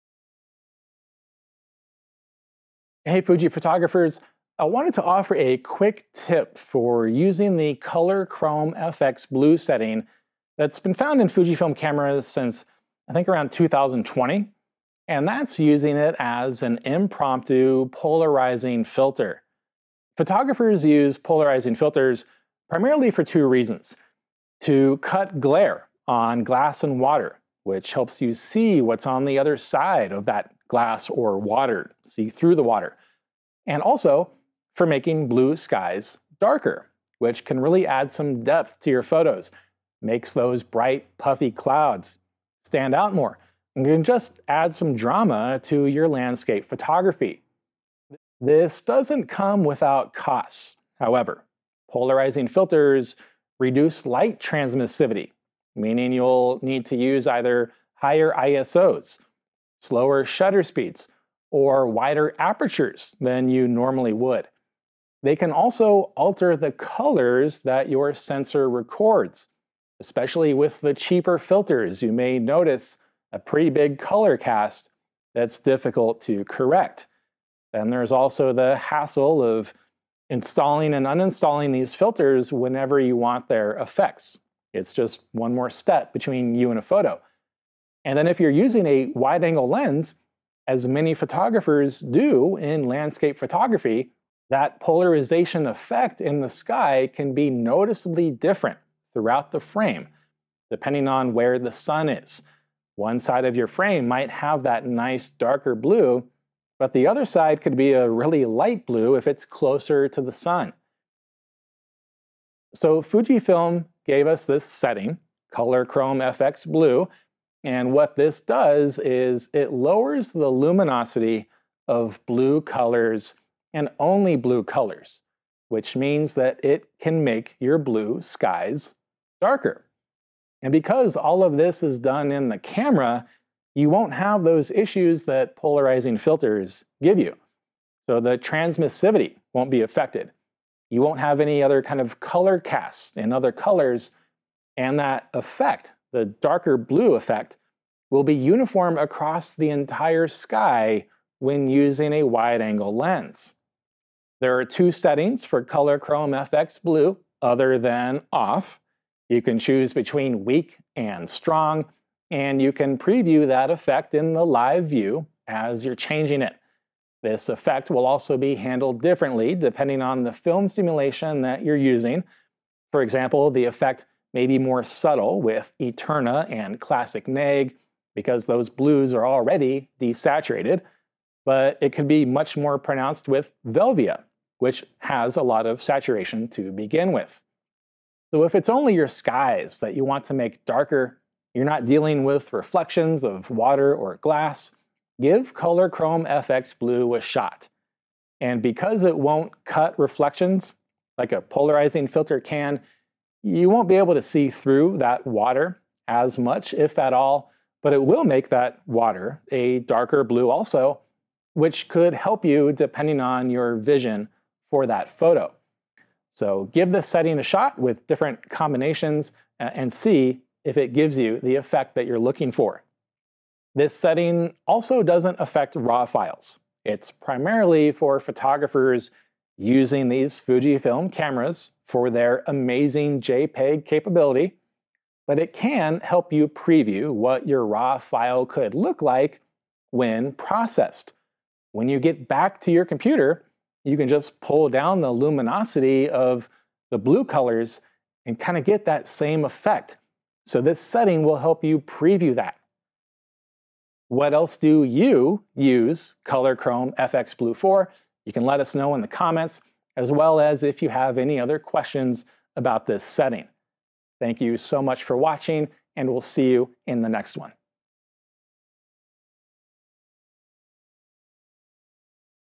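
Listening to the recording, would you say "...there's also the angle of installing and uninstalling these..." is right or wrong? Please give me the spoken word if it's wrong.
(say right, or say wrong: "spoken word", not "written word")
wrong: "hassle", not "angle".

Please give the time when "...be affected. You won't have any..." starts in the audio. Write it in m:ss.
2:19.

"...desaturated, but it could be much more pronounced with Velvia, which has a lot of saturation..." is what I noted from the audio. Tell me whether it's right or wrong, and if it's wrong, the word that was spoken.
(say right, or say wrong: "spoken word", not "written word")
right.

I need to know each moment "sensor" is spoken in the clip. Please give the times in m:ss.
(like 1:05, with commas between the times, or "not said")
1:08.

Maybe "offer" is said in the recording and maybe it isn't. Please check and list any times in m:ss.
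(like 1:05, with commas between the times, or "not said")
0:05.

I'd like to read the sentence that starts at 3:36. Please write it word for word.
So give this setting a shot with different combinations and see if it gives you the effect that you're looking for.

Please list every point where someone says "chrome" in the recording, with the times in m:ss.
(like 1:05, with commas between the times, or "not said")
0:08, 1:55, 2:35, 3:15, 4:16.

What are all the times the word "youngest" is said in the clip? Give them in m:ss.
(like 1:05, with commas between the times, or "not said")
not said.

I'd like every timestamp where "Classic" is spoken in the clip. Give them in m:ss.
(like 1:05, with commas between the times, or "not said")
2:56.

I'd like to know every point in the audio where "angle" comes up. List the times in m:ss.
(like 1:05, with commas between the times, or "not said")
1:29, 2:32.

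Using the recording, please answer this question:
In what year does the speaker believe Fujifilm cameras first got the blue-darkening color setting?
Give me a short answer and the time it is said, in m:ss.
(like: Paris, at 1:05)
2020, at 0:13.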